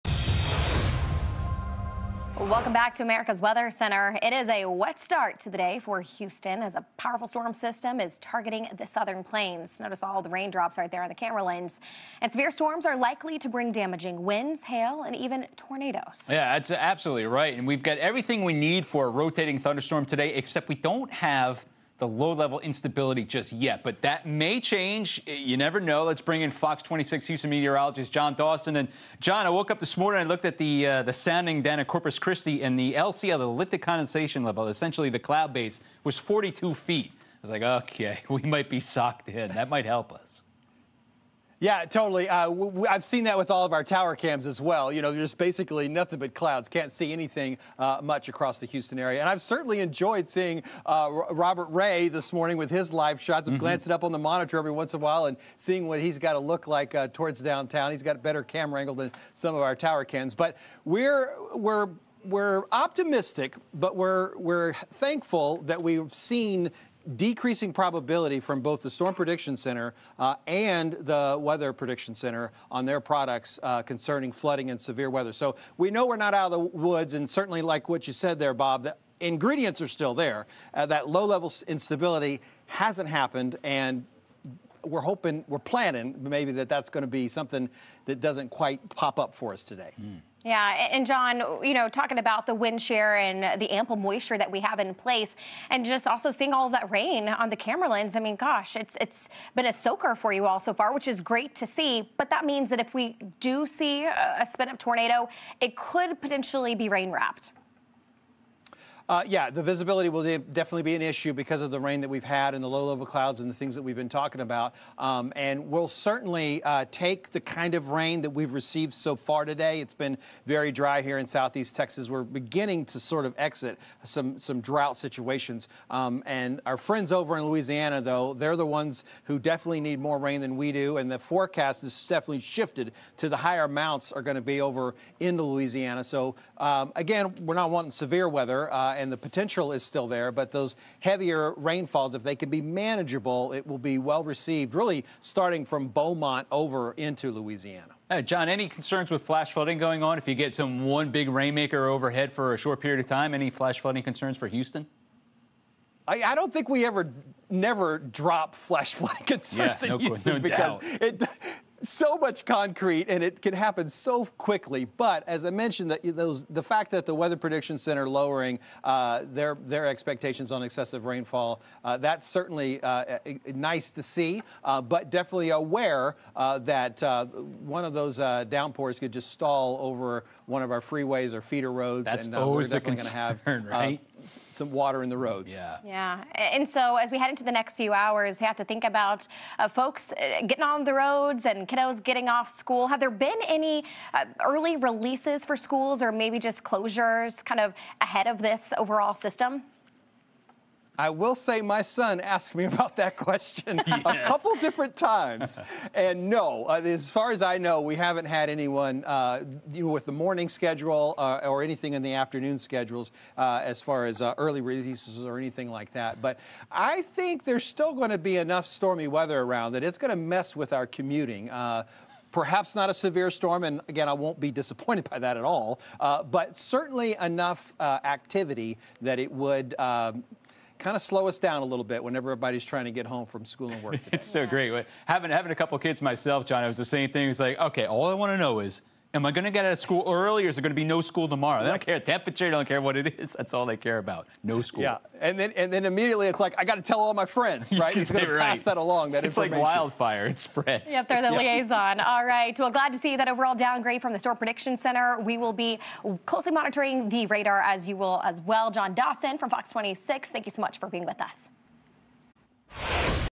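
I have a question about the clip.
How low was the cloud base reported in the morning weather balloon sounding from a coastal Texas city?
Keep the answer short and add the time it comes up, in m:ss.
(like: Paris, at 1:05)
42 feet, at 0:36.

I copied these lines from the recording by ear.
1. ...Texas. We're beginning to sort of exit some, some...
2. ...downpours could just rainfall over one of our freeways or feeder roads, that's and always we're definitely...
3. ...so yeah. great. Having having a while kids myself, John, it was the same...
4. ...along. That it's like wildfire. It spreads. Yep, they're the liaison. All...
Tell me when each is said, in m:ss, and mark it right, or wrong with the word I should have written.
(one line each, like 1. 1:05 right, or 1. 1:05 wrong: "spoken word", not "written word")
1. 2:01 right
2. 2:58 wrong: "stall", not "rainfall"
3. 3:54 wrong: "couple", not "while"
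4. 4:08 right.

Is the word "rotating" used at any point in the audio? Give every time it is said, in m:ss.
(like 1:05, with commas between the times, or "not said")
0:19.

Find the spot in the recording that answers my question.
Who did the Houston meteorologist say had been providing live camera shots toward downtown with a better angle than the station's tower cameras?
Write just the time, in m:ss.
0:51.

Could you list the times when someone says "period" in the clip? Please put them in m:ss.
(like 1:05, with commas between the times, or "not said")
2:32.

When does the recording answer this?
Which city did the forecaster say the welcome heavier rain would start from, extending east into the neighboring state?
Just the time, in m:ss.
2:25.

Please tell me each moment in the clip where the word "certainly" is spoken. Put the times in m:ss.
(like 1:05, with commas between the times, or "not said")
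0:49, 1:17, 1:55, 2:52, 3:46.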